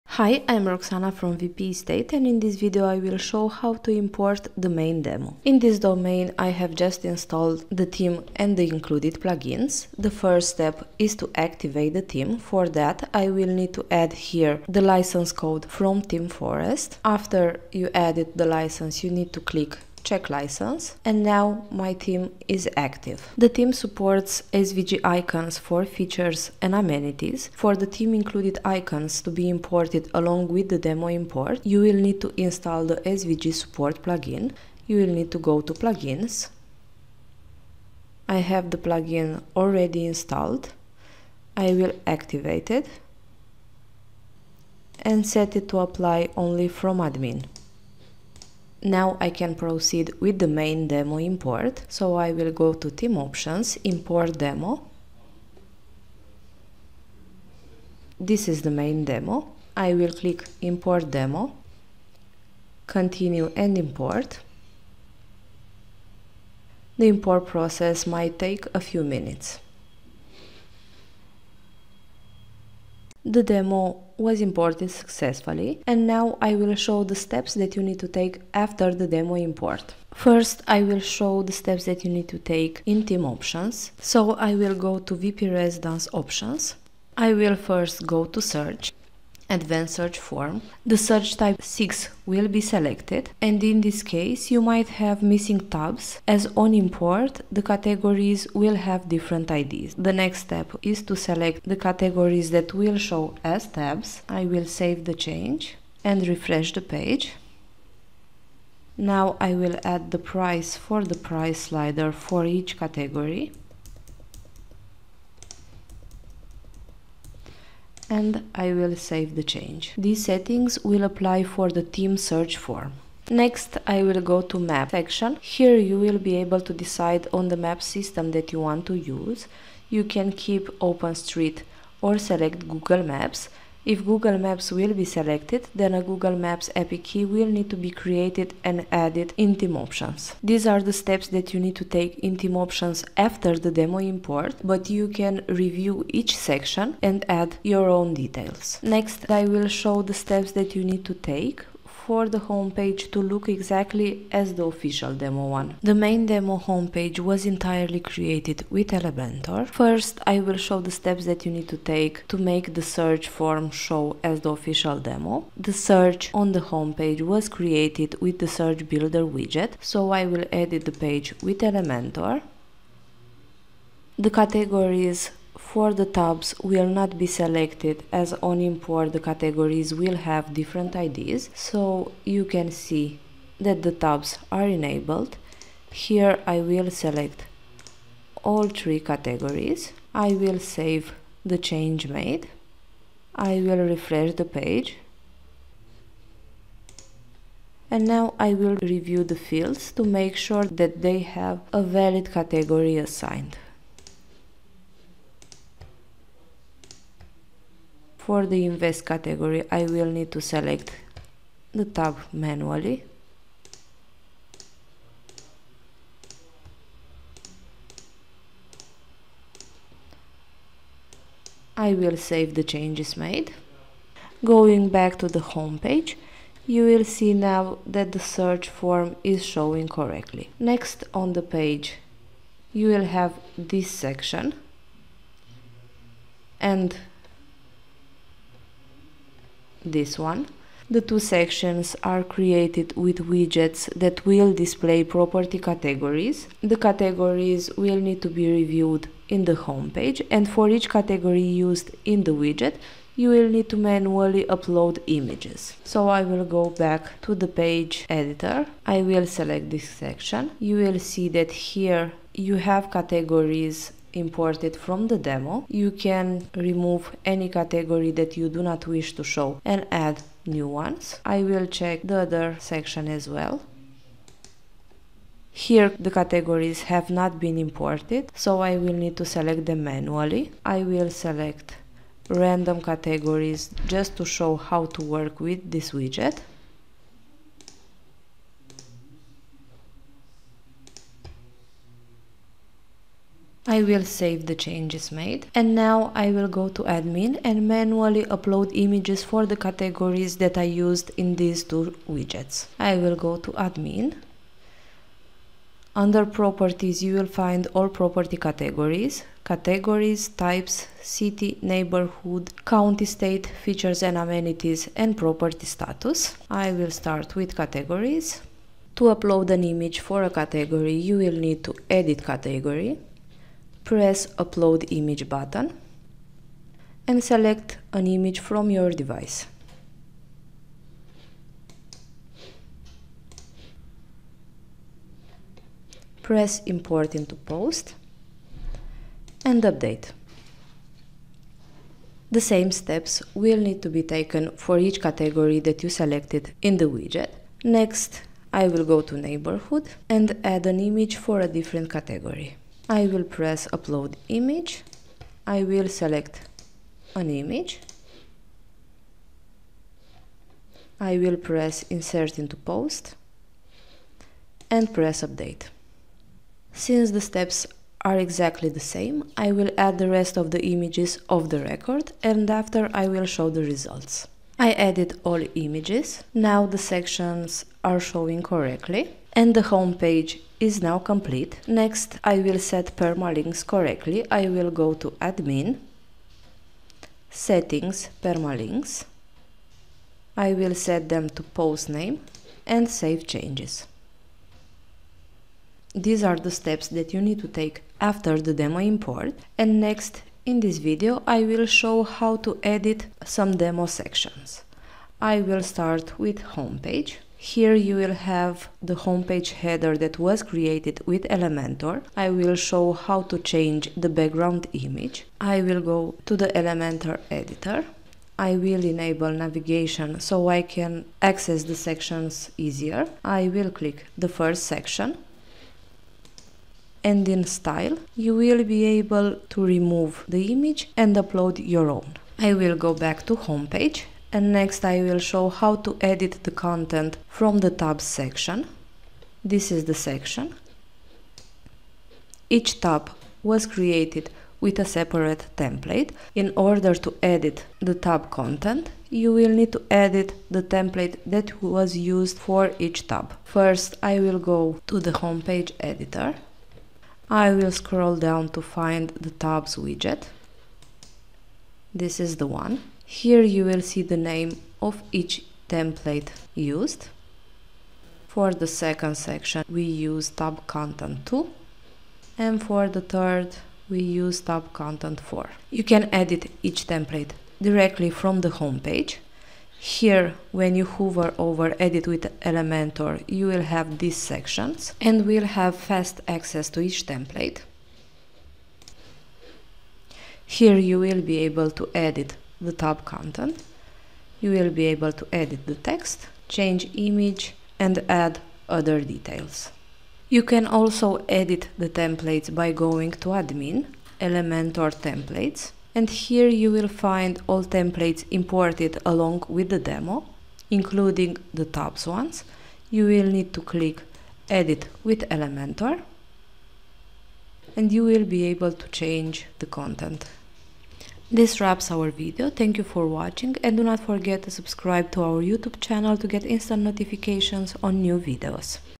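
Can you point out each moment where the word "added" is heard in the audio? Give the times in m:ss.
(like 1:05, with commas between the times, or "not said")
0:17, 2:18, 6:14.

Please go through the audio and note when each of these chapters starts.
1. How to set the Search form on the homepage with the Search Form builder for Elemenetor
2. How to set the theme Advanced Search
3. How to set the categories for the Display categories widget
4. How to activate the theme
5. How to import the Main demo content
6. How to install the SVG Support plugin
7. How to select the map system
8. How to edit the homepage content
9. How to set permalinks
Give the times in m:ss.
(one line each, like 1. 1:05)
1. 2:30
2. 1:26
3. 3:54
4. 0:10
5. 0:50
6. 0:23
7. 2:00
8. 6:40
9. 6:20.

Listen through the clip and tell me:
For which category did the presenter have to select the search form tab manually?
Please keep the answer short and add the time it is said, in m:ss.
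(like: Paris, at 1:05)
invest, at 3:28.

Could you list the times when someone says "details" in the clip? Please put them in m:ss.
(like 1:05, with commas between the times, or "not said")
2:28, 8:19.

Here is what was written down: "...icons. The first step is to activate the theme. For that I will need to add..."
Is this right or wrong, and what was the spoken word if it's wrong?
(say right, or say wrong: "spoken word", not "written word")
wrong: "plugins", not "icons".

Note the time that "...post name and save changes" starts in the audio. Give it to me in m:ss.
6:31.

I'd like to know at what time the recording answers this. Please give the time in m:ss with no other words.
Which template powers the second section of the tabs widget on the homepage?
7:50.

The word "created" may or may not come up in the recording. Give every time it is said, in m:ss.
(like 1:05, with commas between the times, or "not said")
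2:17, 2:37, 2:47, 4:02, 6:50, 7:23.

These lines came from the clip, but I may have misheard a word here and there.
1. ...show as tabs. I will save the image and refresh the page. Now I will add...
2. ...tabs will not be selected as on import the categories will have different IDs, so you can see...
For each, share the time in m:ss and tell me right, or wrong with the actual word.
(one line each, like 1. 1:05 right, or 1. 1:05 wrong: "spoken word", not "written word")
1. 1:42 wrong: "change", not "image"
2. 2:56 right.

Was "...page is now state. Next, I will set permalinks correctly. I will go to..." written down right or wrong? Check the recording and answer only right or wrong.
wrong.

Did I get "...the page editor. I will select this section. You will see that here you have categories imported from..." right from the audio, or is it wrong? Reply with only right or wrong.
right.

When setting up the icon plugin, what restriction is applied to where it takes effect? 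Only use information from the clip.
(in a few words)
only from admin.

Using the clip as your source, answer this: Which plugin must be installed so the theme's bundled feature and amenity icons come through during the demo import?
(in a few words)
SVG support.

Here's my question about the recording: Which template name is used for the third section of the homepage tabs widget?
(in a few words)
tab content 4.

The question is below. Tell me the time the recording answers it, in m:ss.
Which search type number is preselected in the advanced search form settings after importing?
1:30.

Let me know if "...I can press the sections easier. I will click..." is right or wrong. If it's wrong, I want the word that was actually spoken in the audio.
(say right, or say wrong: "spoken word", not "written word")
wrong: "access", not "press".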